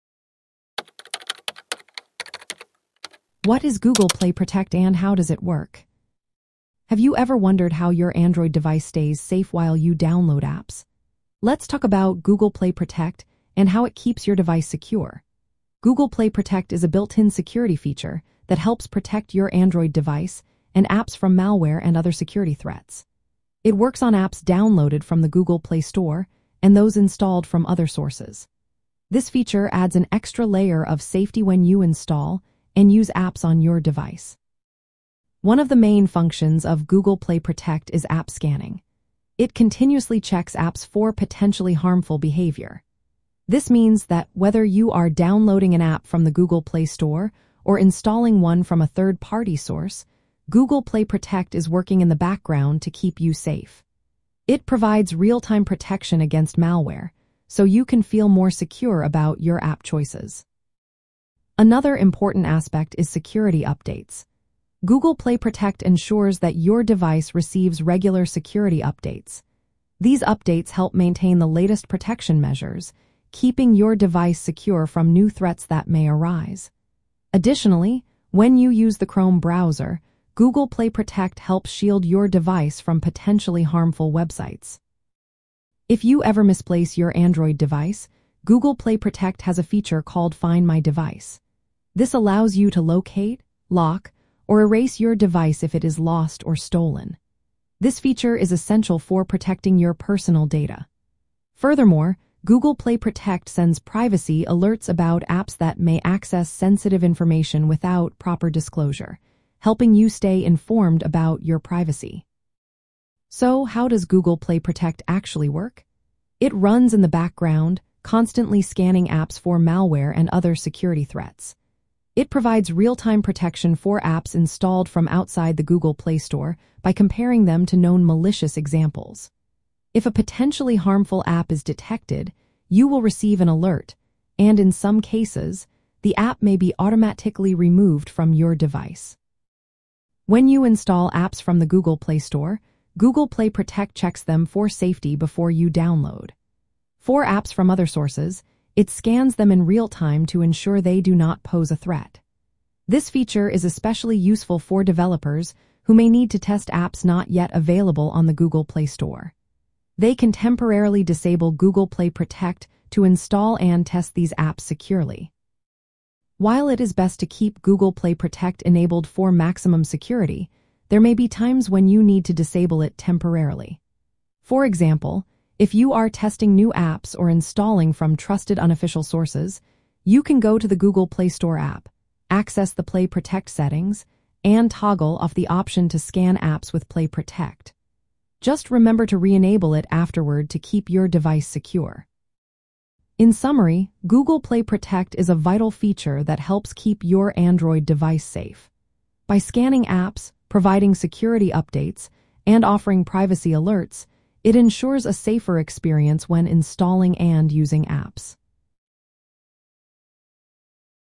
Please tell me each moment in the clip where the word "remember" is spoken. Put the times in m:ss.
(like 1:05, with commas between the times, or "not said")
3:08.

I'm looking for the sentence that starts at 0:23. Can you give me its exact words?
It works on apps downloaded from the Google Play Store and those installed from other sources.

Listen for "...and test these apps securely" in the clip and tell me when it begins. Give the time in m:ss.
2:43.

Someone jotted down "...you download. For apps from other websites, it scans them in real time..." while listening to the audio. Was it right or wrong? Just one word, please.
wrong.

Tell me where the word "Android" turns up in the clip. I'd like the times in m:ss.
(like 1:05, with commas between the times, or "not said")
0:08, 0:19, 1:27, 3:17.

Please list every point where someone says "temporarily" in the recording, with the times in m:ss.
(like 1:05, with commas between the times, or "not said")
2:40, 2:52.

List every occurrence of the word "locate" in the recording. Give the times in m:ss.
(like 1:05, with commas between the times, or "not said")
1:32.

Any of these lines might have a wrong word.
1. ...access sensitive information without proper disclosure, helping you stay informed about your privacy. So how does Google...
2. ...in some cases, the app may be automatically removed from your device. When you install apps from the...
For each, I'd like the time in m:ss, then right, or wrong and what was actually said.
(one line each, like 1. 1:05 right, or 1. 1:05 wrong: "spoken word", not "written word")
1. 1:46 right
2. 2:14 right.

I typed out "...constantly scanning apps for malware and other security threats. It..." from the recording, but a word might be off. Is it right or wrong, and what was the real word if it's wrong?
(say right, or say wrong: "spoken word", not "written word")
right.